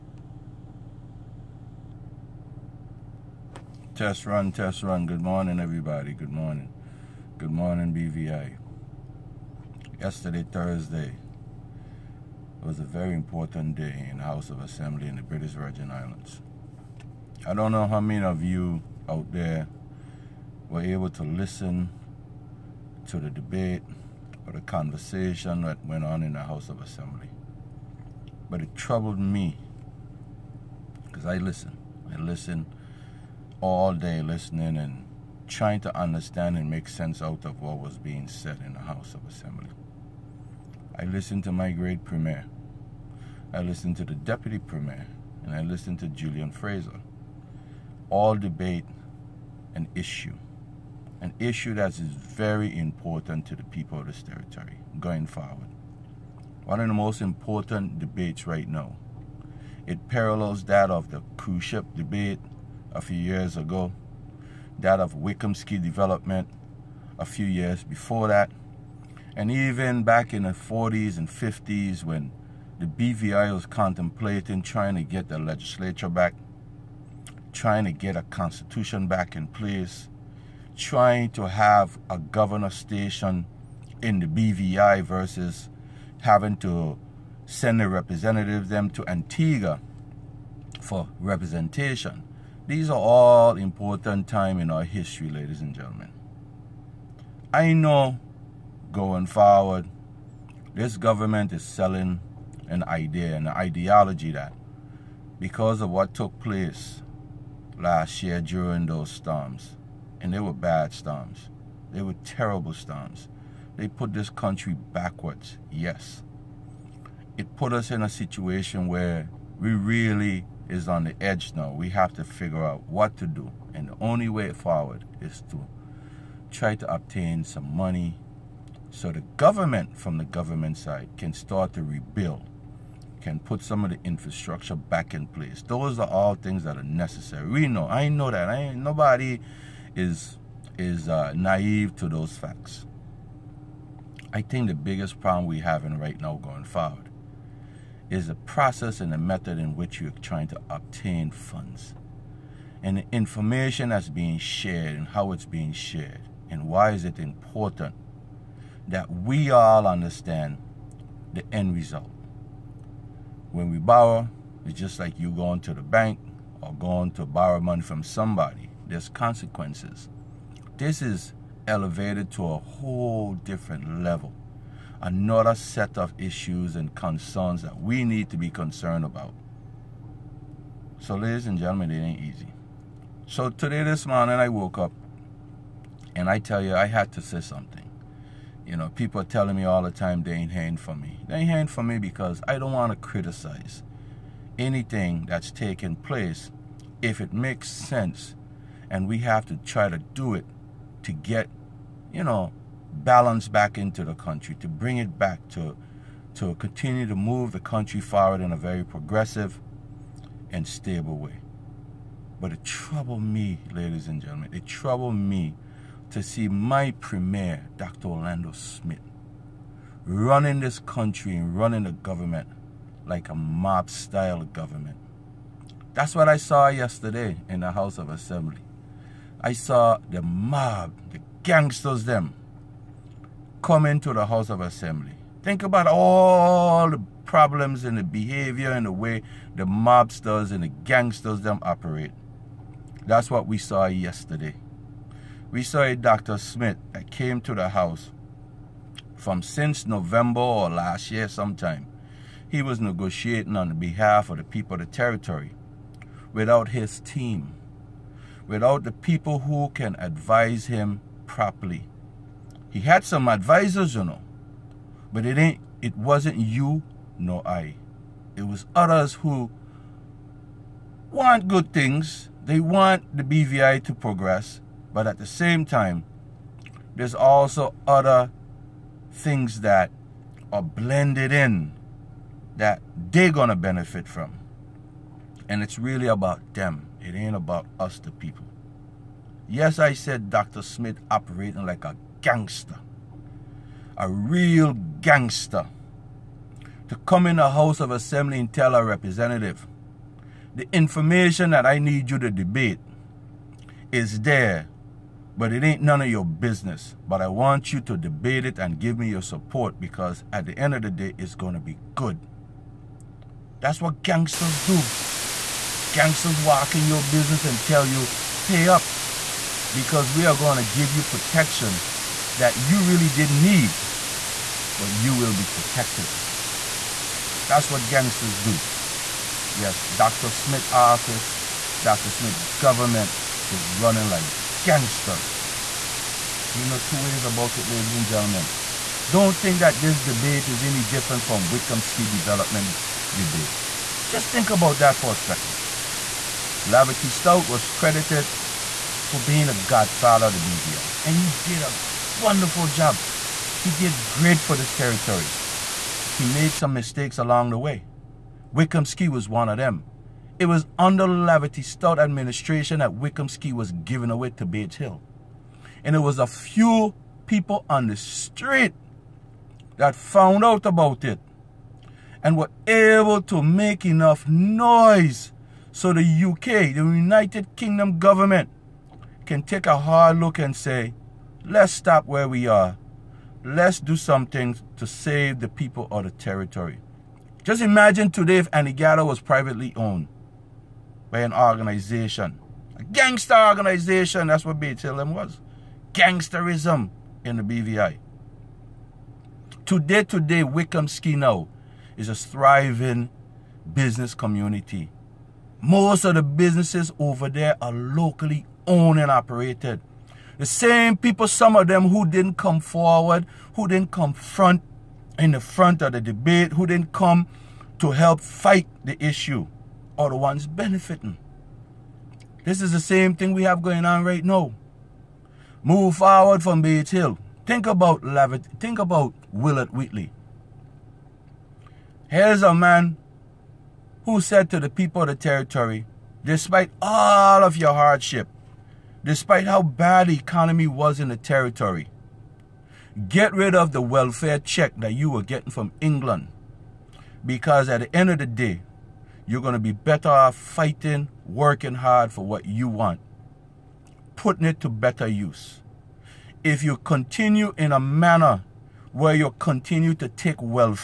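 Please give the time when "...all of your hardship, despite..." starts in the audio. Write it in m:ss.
7:16.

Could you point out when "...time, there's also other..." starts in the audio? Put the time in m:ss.
4:35.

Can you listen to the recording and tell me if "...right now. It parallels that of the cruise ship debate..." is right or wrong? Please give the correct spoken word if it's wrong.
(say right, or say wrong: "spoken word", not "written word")
right.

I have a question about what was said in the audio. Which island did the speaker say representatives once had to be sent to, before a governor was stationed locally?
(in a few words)
Antigua.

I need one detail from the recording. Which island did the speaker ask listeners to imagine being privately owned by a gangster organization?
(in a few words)
Anegada.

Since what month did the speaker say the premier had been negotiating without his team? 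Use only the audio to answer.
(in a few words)
November.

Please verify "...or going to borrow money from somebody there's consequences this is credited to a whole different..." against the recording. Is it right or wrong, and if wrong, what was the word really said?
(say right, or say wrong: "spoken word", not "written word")
wrong: "elevated", not "credited".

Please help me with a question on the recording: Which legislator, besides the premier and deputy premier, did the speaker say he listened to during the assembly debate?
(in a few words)
Julian Fraser.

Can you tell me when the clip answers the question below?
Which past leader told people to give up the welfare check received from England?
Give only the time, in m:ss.
7:09.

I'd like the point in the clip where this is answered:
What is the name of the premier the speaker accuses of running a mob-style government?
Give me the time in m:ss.
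3:37.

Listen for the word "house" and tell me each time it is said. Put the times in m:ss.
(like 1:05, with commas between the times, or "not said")
0:14, 0:26, 0:38, 3:47, 3:54, 4:07, 4:57.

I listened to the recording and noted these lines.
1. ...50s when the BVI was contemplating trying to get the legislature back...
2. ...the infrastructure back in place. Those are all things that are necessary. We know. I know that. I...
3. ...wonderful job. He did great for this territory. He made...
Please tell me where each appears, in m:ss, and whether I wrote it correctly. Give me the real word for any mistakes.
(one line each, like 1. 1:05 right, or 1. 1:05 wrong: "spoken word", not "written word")
1. 1:11 right
2. 2:13 right
3. 5:52 right.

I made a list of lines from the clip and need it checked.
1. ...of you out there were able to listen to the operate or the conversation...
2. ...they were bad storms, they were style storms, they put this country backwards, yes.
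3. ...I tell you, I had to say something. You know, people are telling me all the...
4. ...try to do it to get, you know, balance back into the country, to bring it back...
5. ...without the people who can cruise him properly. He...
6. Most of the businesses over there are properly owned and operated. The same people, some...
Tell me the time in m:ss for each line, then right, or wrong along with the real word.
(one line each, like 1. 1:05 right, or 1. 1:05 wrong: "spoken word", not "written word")
1. 0:18 wrong: "debate", not "operate"
2. 1:50 wrong: "terrible", not "style"
3. 3:06 right
4. 3:19 right
5. 4:18 wrong: "advise", not "cruise"
6. 6:45 wrong: "locally", not "properly".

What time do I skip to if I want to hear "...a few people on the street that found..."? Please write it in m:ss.
6:06.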